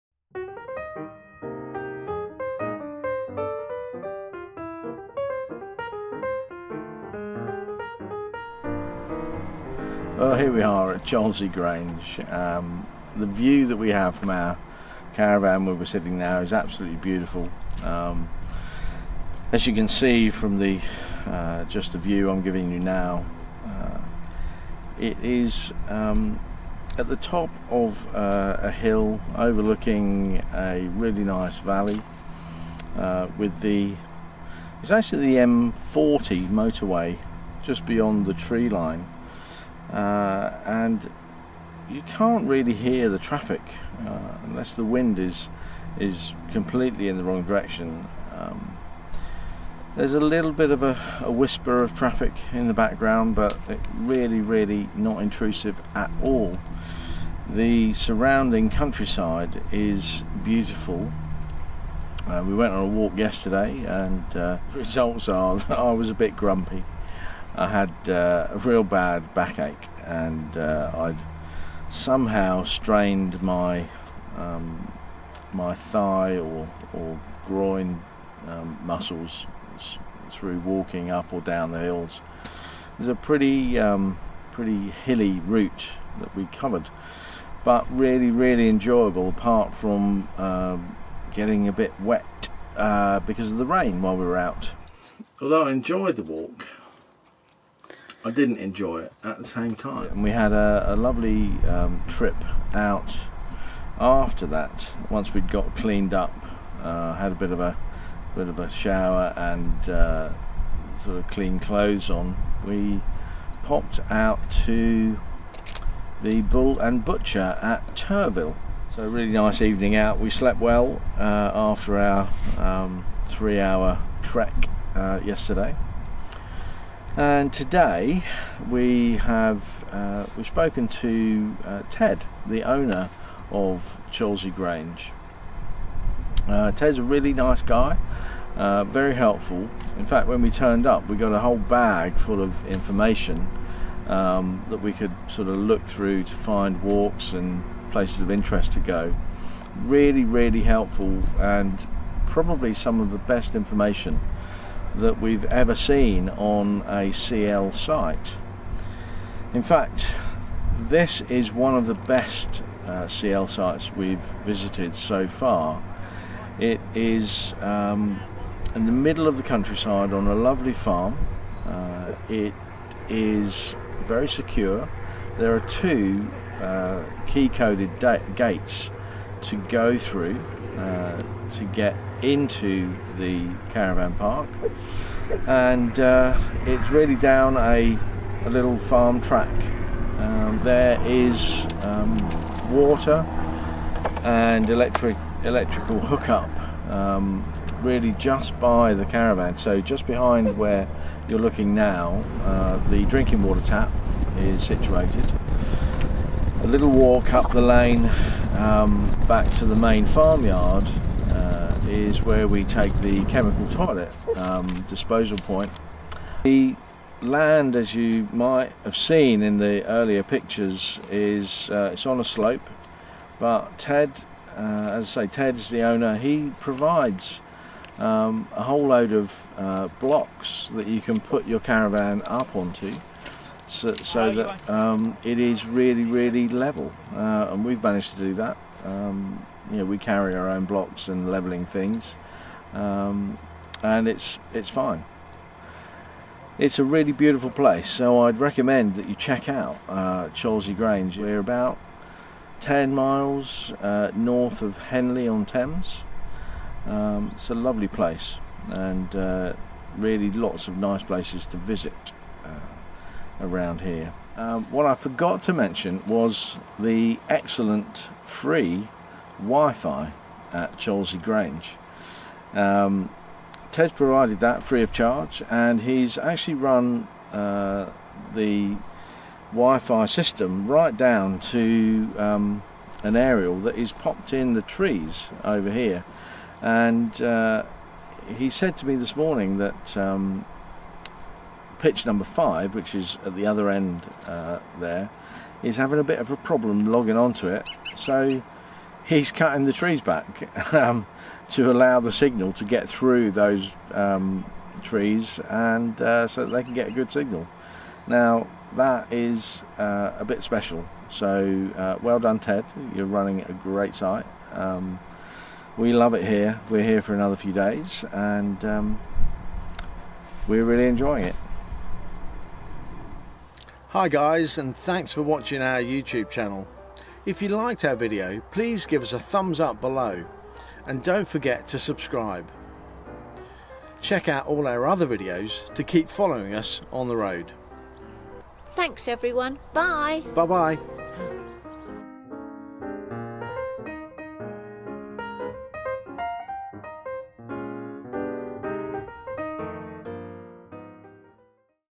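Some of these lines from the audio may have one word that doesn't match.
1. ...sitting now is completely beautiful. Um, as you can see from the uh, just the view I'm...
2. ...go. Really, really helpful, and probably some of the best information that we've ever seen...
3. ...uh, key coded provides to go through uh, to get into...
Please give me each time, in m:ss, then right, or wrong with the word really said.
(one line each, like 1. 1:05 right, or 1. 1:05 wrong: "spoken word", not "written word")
1. 0:15 wrong: "absolutely", not "completely"
2. 2:28 right
3. 2:56 wrong: "gates", not "provides".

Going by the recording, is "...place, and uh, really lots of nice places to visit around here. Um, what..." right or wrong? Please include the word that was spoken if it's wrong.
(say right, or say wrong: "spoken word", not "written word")
right.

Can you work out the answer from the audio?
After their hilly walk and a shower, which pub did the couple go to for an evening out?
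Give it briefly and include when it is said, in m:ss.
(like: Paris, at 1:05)
Bull and Butcher, at 1:56.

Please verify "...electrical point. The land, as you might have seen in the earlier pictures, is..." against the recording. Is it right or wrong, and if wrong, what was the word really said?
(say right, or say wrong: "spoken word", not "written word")
wrong: "disposal", not "electrical".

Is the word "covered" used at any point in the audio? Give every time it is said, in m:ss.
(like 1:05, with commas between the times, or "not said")
1:26.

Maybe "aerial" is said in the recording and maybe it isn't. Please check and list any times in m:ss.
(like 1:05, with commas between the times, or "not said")
4:43.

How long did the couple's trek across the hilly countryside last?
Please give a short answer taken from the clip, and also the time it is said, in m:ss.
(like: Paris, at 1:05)
3 hours, at 2:03.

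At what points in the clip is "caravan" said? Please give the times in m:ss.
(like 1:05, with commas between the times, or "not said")
0:15, 3:03, 3:19, 3:51.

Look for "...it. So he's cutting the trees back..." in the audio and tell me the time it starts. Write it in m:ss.
4:57.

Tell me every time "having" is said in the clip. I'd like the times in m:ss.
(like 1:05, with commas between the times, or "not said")
4:55.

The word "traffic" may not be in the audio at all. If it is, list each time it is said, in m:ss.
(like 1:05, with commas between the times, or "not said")
0:43, 0:51.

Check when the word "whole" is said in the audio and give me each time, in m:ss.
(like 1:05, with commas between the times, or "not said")
2:21, 3:48.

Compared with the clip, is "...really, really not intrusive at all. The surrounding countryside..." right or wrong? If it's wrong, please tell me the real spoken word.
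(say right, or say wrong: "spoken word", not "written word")
right.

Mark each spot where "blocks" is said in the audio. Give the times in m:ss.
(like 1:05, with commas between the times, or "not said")
3:49, 4:00.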